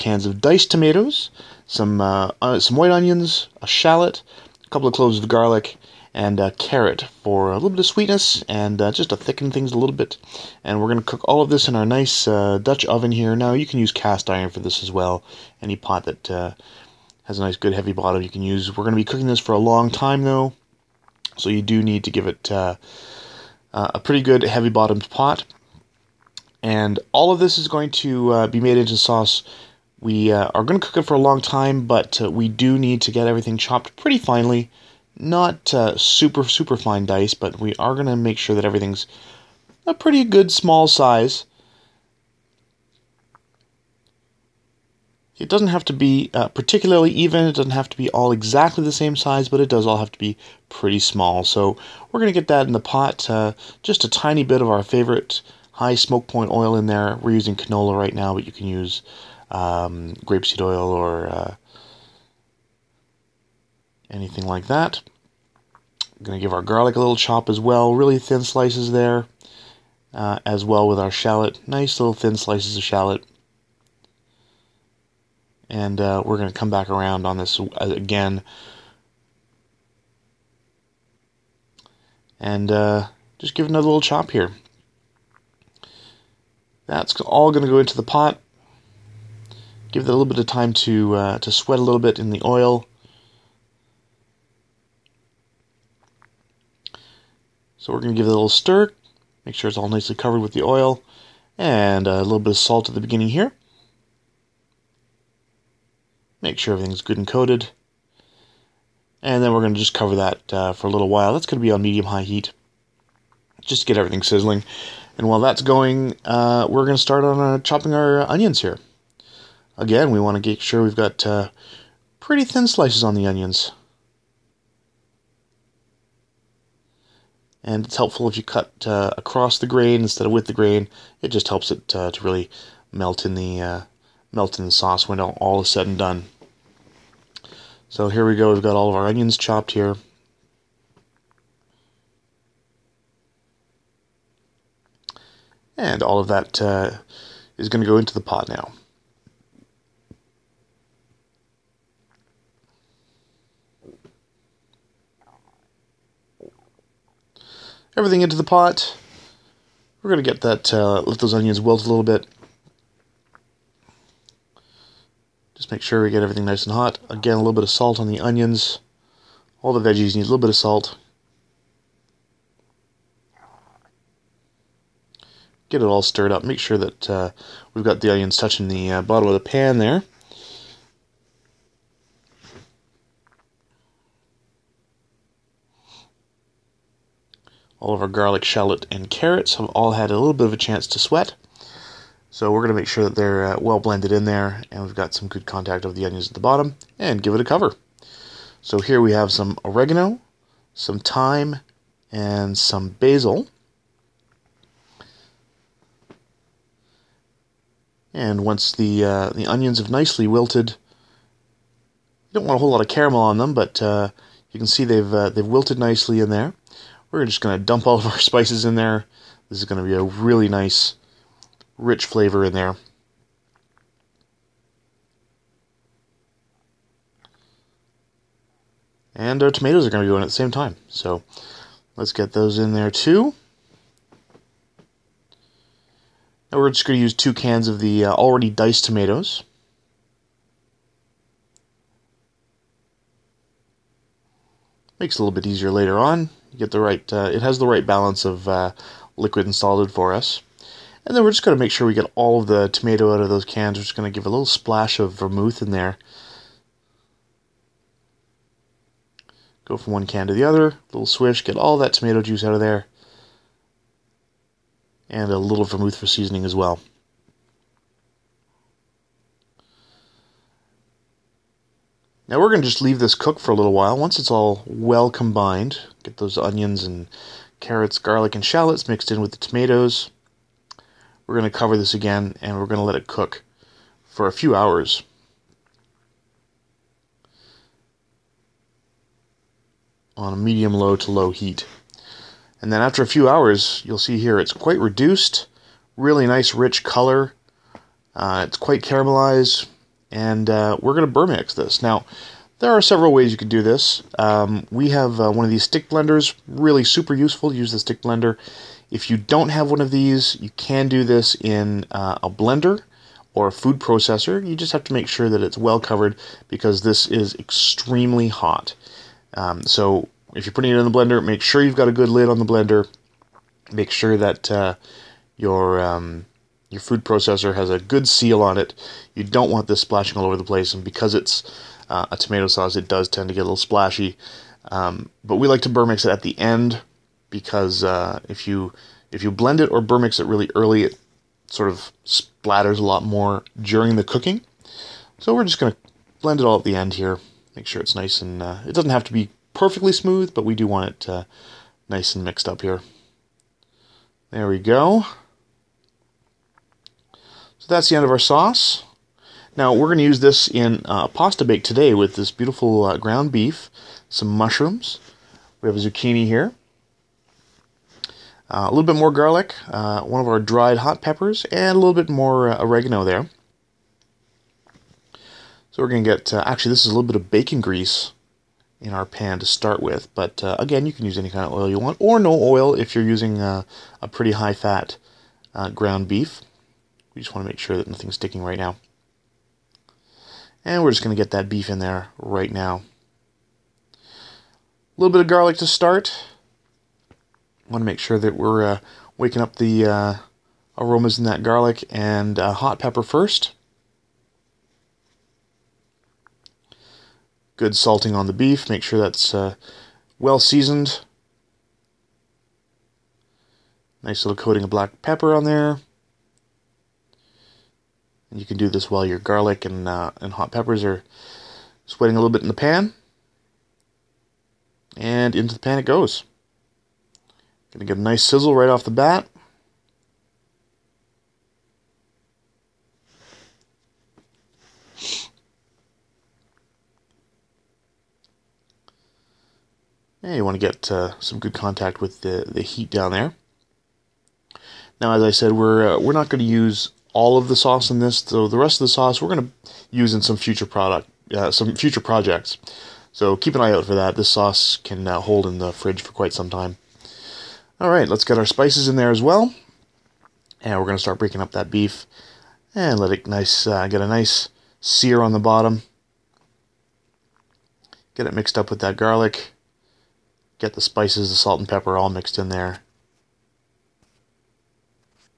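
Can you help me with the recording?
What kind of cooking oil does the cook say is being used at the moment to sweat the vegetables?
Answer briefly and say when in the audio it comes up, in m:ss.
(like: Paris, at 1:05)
canola, at 0:57.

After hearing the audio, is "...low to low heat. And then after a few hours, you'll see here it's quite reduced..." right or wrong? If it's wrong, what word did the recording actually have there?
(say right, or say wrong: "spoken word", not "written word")
right.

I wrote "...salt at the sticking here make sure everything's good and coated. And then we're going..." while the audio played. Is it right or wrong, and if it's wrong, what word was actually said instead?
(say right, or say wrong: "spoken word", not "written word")
wrong: "beginning", not "sticking".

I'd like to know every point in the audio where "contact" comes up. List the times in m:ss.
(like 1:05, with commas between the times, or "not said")
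3:15, 7:21.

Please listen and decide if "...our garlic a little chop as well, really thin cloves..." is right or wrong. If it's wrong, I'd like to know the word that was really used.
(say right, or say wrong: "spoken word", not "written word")
wrong: "slices", not "cloves".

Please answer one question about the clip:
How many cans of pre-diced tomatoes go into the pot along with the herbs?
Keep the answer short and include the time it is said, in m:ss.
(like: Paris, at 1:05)
2, at 3:57.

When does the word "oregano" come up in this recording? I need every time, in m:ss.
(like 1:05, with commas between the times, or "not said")
3:19, 6:12.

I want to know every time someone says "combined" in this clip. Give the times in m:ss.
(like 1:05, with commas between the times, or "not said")
4:35.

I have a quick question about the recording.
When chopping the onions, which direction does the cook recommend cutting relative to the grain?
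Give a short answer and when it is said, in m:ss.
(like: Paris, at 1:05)
across the grain, at 2:09.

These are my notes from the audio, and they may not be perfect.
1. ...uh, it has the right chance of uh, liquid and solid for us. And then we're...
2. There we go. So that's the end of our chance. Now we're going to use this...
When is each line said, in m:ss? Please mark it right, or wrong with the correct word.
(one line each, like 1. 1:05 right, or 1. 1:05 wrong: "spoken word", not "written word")
1. 4:07 wrong: "balance", not "chance"
2. 5:54 wrong: "sauce", not "chance".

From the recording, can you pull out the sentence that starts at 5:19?
Um, so if you're putting it in the blender, make sure you've got a good lid on the blender.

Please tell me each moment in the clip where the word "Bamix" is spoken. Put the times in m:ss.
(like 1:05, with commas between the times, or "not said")
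5:01, 5:35, 5:39.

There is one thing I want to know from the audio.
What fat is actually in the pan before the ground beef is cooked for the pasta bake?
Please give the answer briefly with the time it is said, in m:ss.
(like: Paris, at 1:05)
bacon grease, at 6:17.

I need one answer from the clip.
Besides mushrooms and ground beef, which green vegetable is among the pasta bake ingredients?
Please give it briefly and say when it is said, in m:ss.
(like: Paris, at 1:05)
zucchini, at 6:05.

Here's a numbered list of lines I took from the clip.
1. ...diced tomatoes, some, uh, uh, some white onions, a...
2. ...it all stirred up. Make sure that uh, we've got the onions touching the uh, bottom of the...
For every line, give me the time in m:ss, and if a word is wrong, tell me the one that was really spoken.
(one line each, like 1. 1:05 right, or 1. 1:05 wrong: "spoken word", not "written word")
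1. 0:00 right
2. 2:55 right.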